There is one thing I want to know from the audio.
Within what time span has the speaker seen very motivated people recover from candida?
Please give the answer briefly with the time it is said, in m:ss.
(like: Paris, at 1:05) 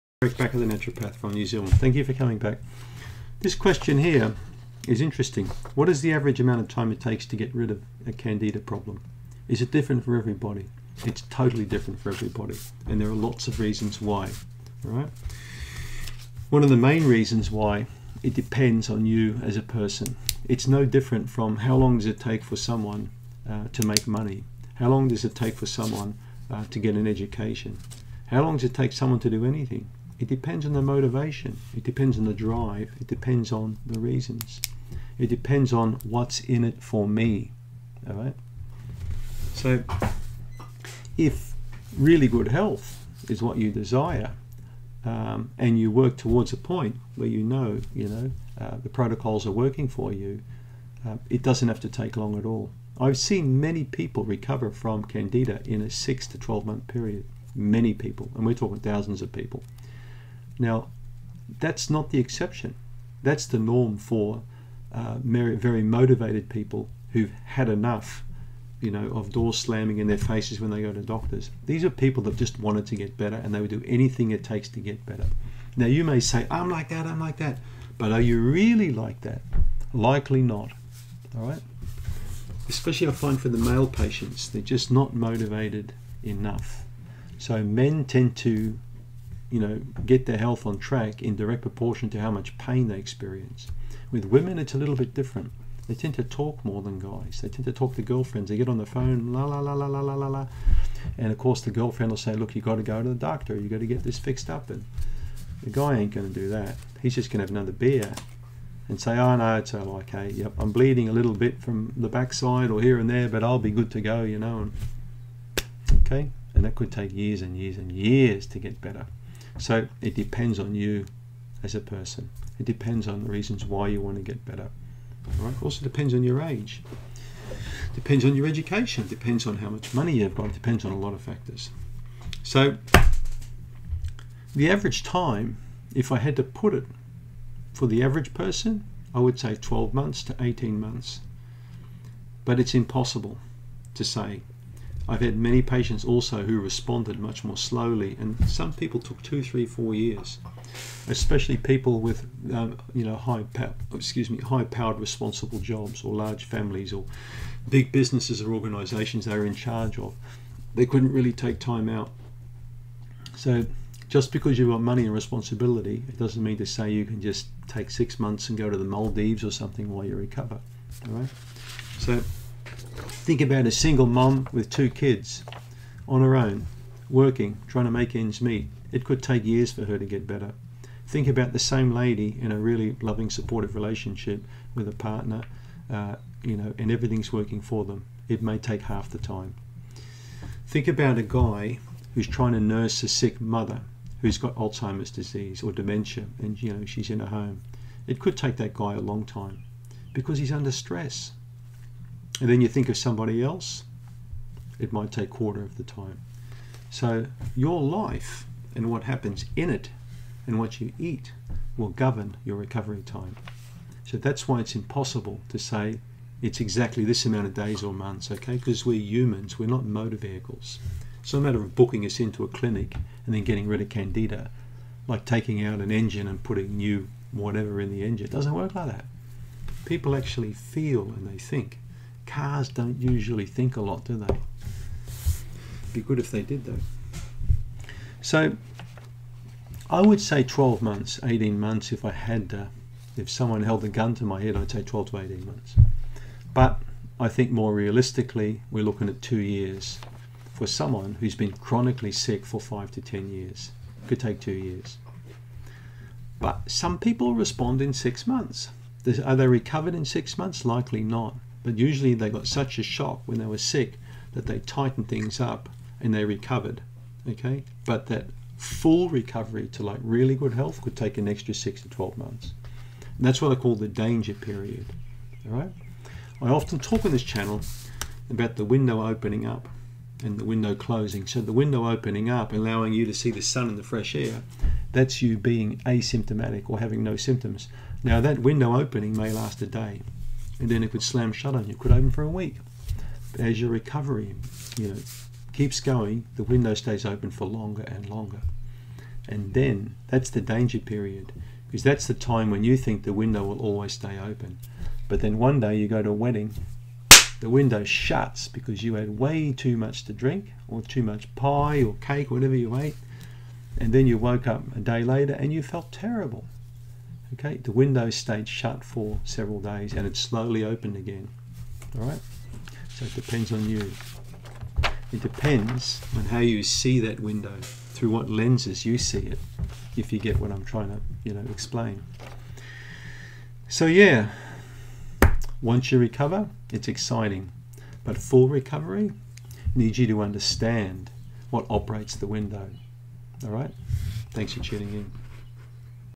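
6 to 12 months, at 0:55.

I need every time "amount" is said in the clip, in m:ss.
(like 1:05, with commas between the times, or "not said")
0:06, 3:37.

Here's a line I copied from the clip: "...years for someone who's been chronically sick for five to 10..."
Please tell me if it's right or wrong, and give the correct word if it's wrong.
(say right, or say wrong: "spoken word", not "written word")
right.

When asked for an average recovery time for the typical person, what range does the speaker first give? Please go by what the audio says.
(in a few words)
12 to 18 months.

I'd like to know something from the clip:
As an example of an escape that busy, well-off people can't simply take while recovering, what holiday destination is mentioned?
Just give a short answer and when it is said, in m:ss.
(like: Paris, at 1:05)
Maldives, at 2:48.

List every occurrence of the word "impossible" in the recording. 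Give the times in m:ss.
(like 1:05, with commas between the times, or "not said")
2:22, 3:34.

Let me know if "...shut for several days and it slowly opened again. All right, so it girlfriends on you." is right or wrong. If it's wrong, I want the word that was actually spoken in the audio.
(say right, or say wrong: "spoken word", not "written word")
wrong: "depends", not "girlfriends".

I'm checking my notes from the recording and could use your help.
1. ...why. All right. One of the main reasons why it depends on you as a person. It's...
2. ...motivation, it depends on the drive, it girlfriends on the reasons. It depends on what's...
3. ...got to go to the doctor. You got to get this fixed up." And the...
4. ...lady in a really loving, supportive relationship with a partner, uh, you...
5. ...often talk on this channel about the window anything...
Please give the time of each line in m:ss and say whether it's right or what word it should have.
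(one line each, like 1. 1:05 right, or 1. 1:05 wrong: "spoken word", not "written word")
1. 0:13 right
2. 0:30 wrong: "depends", not "girlfriends"
3. 1:42 right
4. 3:01 right
5. 4:36 wrong: "opening", not "anything".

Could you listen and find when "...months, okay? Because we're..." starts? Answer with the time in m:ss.
3:37.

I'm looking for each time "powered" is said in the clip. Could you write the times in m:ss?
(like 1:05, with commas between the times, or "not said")
2:34.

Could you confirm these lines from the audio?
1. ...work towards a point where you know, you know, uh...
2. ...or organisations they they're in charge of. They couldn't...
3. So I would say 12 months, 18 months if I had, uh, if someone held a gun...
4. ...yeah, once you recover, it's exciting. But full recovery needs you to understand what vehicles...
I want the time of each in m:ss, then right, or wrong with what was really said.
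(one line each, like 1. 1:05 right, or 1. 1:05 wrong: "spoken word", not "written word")
1. 0:45 right
2. 2:38 right
3. 3:58 right
4. 5:33 wrong: "operates", not "vehicles".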